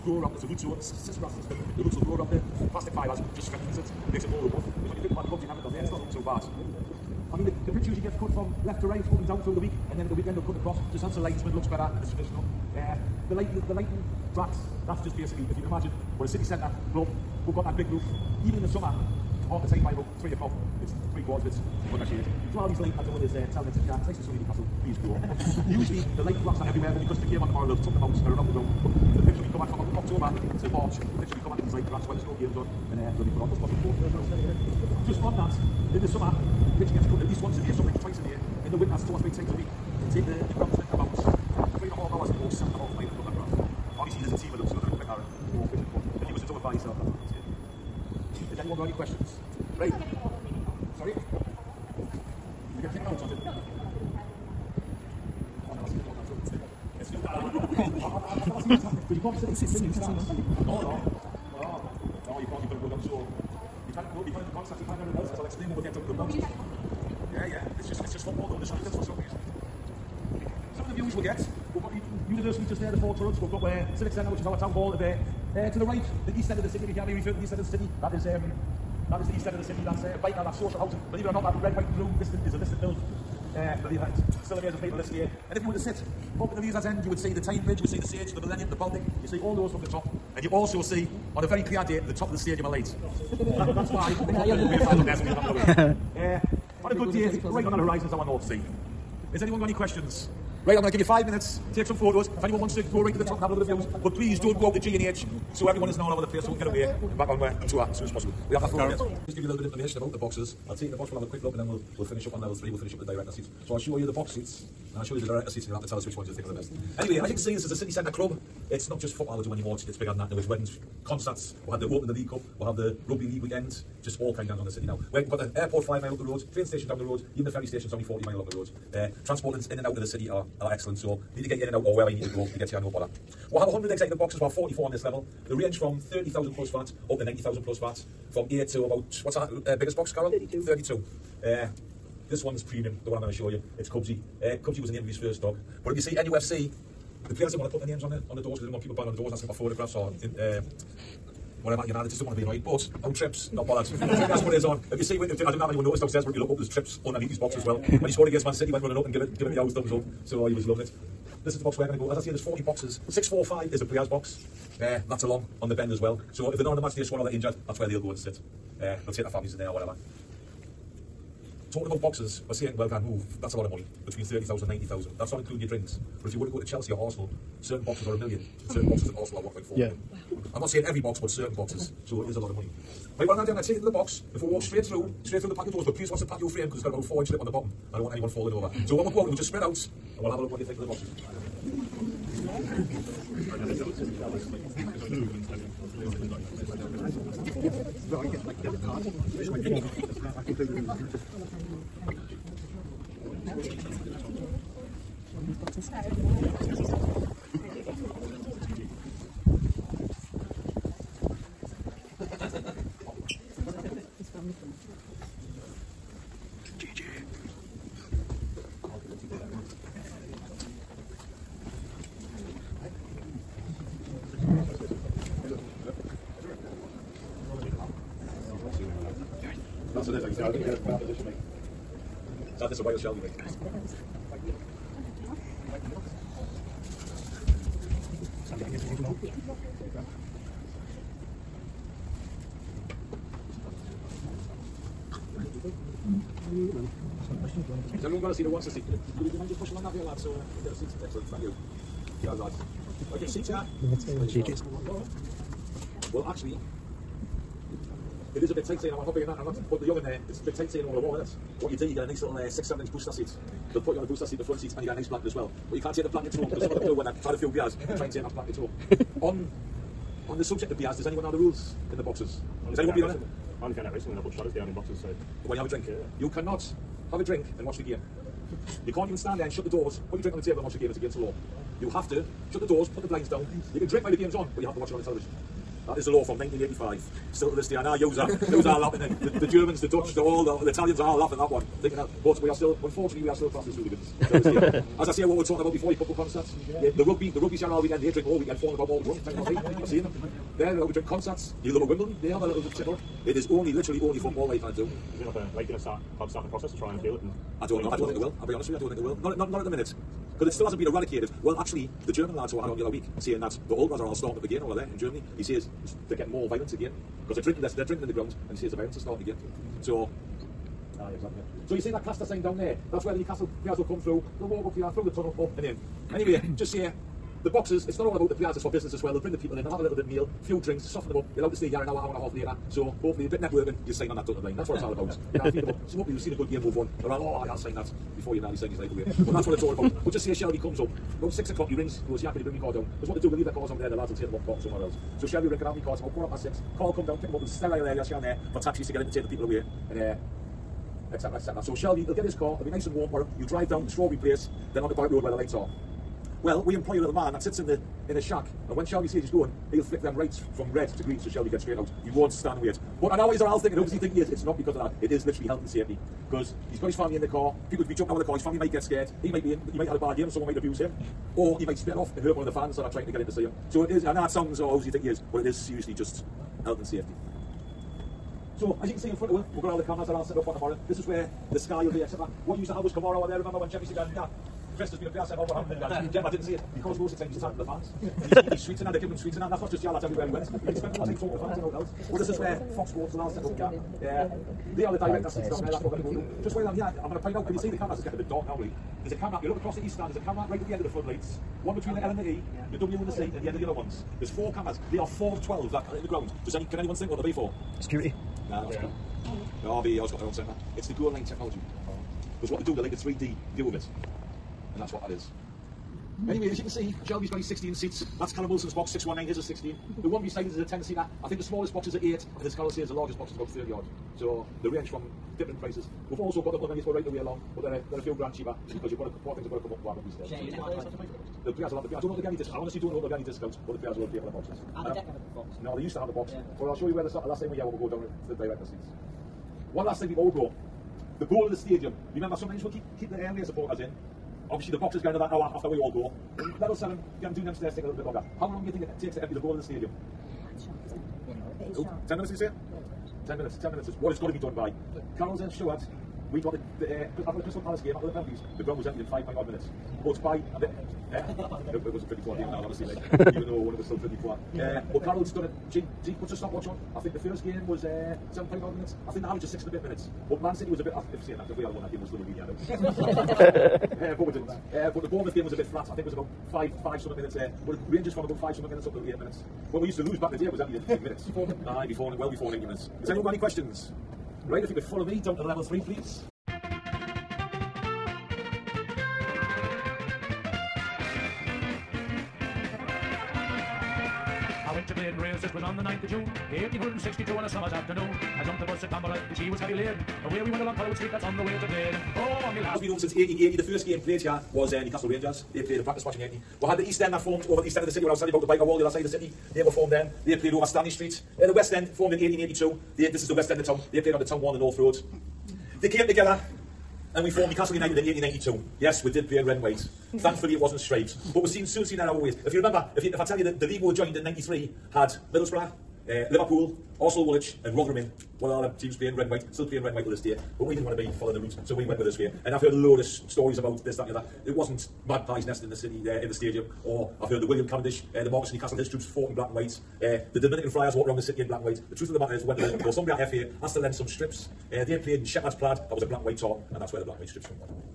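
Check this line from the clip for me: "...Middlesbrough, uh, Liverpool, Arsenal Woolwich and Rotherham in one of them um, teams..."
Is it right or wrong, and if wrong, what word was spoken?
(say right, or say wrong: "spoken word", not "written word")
right.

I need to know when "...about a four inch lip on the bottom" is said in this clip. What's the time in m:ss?
3:06.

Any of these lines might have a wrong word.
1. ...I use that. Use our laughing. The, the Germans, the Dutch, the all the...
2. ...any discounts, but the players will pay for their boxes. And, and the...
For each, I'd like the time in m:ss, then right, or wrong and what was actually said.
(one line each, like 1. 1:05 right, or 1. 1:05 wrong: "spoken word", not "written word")
1. 4:47 right
2. 7:13 right.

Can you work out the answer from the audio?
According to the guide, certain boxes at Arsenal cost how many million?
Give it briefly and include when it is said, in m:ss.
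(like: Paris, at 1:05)
1.4 million, at 2:59.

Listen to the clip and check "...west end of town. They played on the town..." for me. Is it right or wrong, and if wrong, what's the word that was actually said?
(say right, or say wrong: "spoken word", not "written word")
right.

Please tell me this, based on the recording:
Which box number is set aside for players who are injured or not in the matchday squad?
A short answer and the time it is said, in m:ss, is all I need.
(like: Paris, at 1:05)
645, at 2:43.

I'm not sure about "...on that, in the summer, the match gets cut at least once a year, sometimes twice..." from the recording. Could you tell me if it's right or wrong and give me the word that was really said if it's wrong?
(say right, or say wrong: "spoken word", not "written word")
wrong: "pitch", not "match".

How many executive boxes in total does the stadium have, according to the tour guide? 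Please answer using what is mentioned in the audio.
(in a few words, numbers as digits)
100.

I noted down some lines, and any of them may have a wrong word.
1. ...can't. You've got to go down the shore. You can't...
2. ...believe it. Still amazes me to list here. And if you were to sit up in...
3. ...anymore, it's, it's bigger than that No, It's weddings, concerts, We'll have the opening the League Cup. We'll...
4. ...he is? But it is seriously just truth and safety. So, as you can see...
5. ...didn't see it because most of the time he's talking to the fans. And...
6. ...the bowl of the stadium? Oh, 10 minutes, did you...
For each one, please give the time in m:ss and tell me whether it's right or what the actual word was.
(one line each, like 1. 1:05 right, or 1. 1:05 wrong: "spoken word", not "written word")
1. 1:02 right
2. 1:23 right
3. 1:59 right
4. 6:15 wrong: "health", not "truth"
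5. 6:26 right
6. 7:29 right.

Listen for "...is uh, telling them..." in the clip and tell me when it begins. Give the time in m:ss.
0:23.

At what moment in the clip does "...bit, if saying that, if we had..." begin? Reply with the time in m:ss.
7:50.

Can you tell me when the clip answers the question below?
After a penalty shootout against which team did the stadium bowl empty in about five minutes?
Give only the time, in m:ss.
7:37.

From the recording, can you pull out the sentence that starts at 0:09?
And then at the weekend they'll cut across, just helps the linesman, looks better, and it's traditional.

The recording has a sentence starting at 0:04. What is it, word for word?
Because when you think about the bugs never done there, it's not looking so bad.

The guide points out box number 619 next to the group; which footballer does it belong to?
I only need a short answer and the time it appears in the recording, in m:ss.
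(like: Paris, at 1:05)
Callum Wilson, at 6:58.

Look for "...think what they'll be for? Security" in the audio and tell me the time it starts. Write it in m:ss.
6:46.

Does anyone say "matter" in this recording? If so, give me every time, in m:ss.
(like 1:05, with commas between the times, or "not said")
9:02.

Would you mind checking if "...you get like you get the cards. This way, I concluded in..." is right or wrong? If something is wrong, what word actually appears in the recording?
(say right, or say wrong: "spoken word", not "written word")
right.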